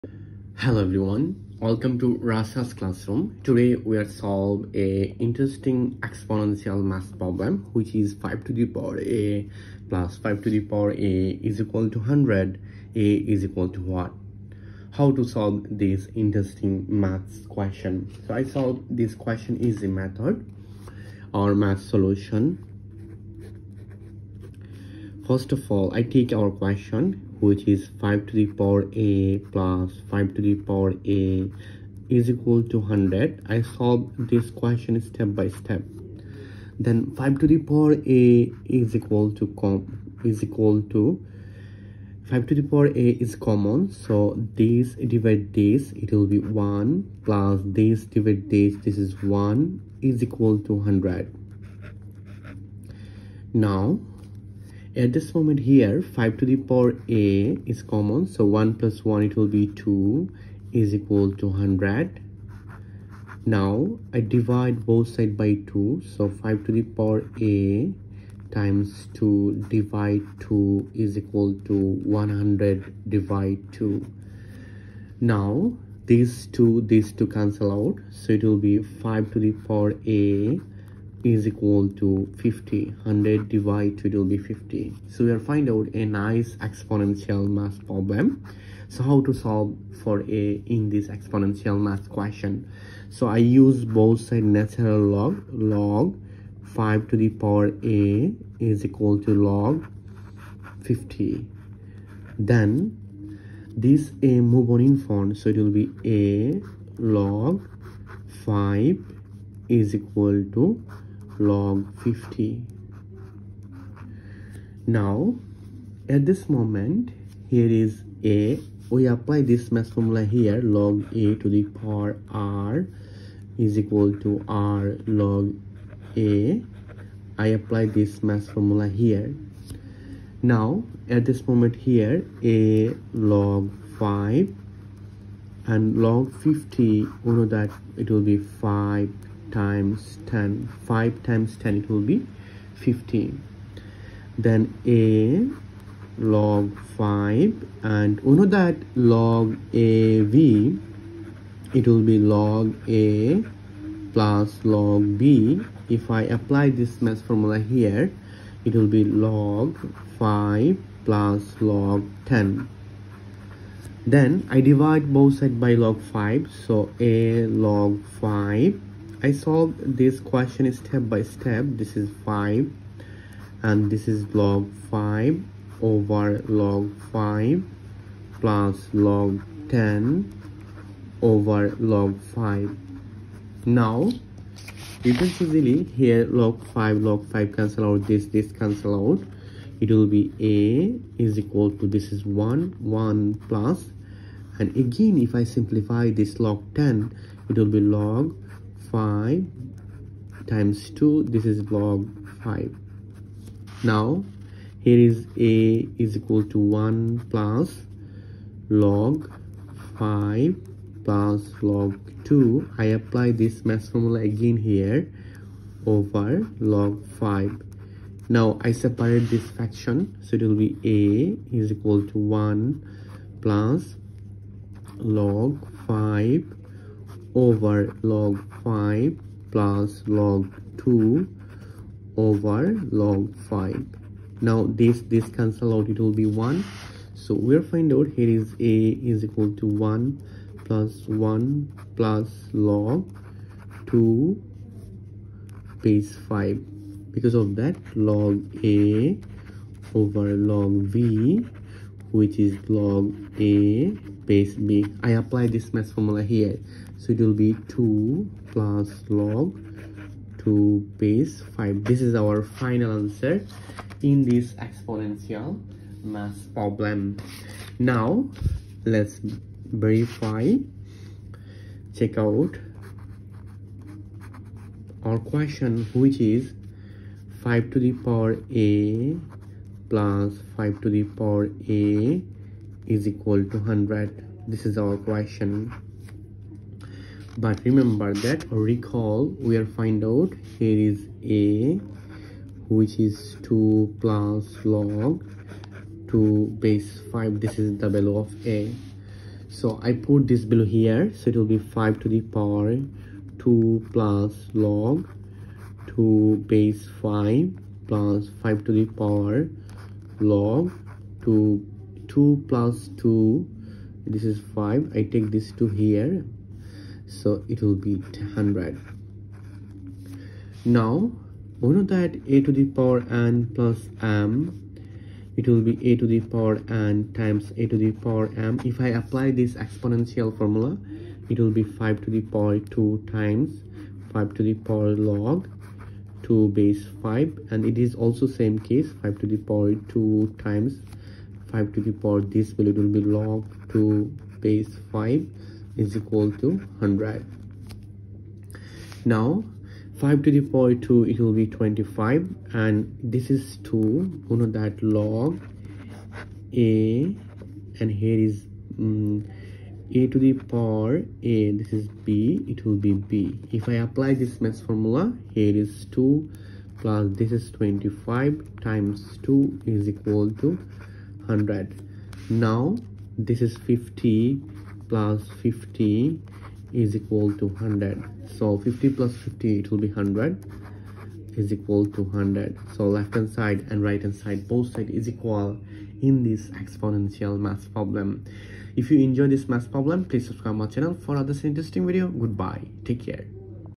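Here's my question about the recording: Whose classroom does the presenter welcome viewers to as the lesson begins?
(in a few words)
Rashel's classroom.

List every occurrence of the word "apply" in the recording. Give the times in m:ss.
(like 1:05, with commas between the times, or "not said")
1:59, 2:07, 2:36, 3:32, 4:15, 5:29, 6:03.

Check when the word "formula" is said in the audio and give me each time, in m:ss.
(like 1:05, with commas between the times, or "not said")
1:59, 2:08, 2:37, 3:33, 4:15, 5:30, 6:04.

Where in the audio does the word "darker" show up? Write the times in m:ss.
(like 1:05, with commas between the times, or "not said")
not said.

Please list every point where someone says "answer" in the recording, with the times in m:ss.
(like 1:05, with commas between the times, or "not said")
4:22.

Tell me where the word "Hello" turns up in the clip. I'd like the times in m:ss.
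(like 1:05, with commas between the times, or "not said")
0:00.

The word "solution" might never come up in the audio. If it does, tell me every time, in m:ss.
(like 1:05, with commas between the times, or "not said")
0:21.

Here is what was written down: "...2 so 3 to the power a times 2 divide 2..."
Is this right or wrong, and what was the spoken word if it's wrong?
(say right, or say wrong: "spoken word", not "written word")
wrong: "5", not "3".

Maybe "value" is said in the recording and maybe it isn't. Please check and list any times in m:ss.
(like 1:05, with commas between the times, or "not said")
4:57, 5:42.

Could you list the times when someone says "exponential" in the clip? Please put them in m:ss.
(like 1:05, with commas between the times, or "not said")
0:06, 1:26, 1:31, 4:24, 5:29, 6:26.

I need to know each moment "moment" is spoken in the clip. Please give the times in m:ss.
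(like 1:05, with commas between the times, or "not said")
0:55, 1:56, 2:11.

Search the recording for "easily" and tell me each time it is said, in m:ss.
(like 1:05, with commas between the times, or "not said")
3:05.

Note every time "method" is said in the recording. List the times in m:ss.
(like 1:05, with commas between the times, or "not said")
0:19.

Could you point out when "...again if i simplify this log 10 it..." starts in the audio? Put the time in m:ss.
3:14.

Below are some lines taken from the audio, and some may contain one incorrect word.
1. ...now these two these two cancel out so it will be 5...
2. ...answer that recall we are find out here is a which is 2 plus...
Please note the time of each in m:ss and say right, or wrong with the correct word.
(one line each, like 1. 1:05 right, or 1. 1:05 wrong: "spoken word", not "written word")
1. 1:15 right
2. 4:47 wrong: "remember", not "answer".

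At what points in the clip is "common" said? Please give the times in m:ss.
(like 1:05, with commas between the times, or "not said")
0:43, 0:57.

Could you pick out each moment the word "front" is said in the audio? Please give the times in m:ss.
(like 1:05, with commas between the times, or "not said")
1:44.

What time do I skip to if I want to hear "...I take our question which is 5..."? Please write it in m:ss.
0:25.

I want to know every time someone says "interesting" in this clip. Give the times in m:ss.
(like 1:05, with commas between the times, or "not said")
0:05, 0:16, 6:31.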